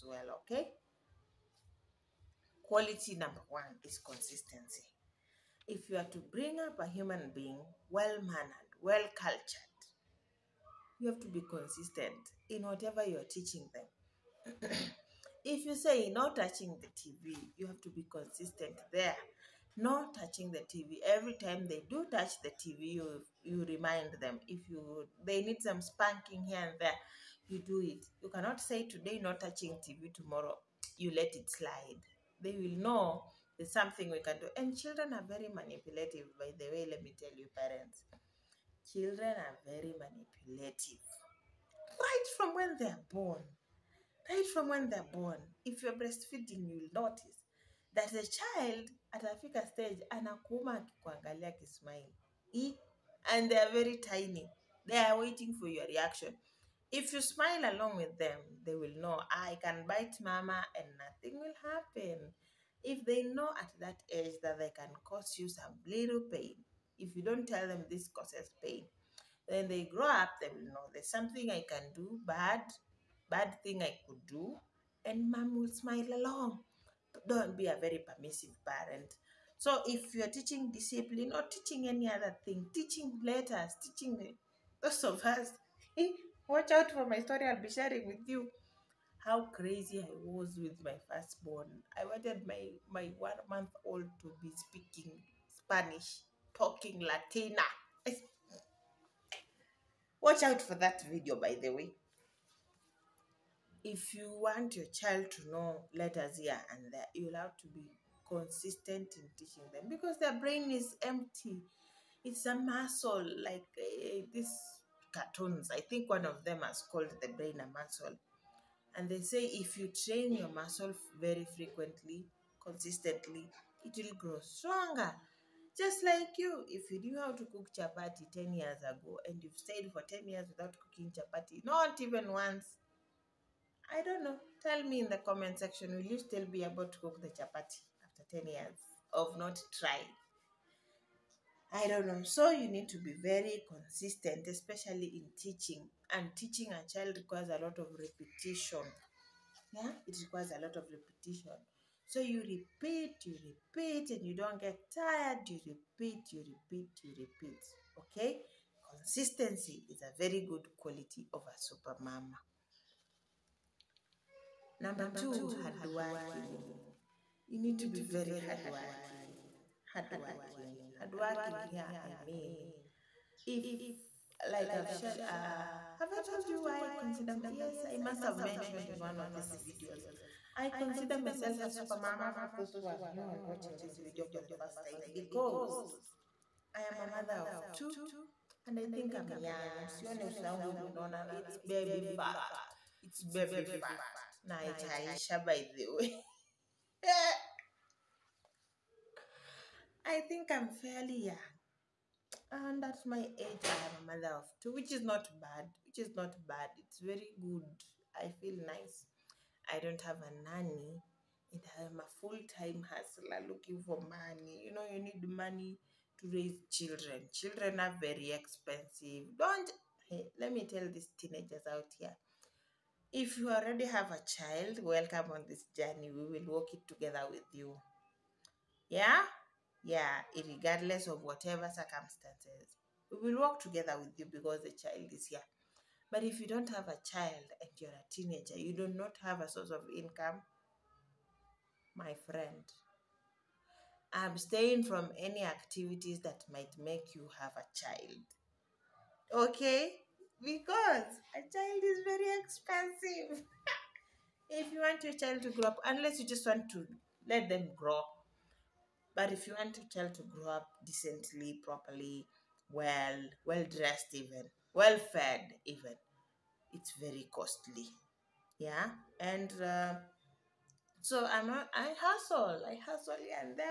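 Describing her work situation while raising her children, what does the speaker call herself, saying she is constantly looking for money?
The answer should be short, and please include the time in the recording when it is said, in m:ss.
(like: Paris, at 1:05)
Full time hustler, at 3:32.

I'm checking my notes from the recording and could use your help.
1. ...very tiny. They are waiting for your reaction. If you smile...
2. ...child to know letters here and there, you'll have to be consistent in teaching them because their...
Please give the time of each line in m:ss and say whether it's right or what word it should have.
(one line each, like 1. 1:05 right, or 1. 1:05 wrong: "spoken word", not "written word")
1. 0:53 right
2. 1:44 right.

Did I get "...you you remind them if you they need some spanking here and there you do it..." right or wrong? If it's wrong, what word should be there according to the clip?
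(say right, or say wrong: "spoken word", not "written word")
right.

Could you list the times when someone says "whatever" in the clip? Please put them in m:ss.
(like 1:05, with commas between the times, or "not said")
0:12, 3:51.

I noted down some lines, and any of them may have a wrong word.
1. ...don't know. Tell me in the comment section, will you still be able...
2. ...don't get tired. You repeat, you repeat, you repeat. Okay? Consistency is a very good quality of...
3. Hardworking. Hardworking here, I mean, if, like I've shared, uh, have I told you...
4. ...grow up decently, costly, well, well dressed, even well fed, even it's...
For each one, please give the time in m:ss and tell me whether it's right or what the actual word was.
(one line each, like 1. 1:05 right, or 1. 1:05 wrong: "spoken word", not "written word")
1. 2:14 right
2. 2:34 right
3. 2:49 right
4. 4:20 wrong: "properly", not "costly".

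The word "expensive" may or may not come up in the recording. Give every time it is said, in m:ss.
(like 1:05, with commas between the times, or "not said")
3:38, 4:12.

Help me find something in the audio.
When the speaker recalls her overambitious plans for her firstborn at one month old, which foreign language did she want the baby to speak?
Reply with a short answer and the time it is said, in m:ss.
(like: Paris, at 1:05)
Spanish, at 1:35.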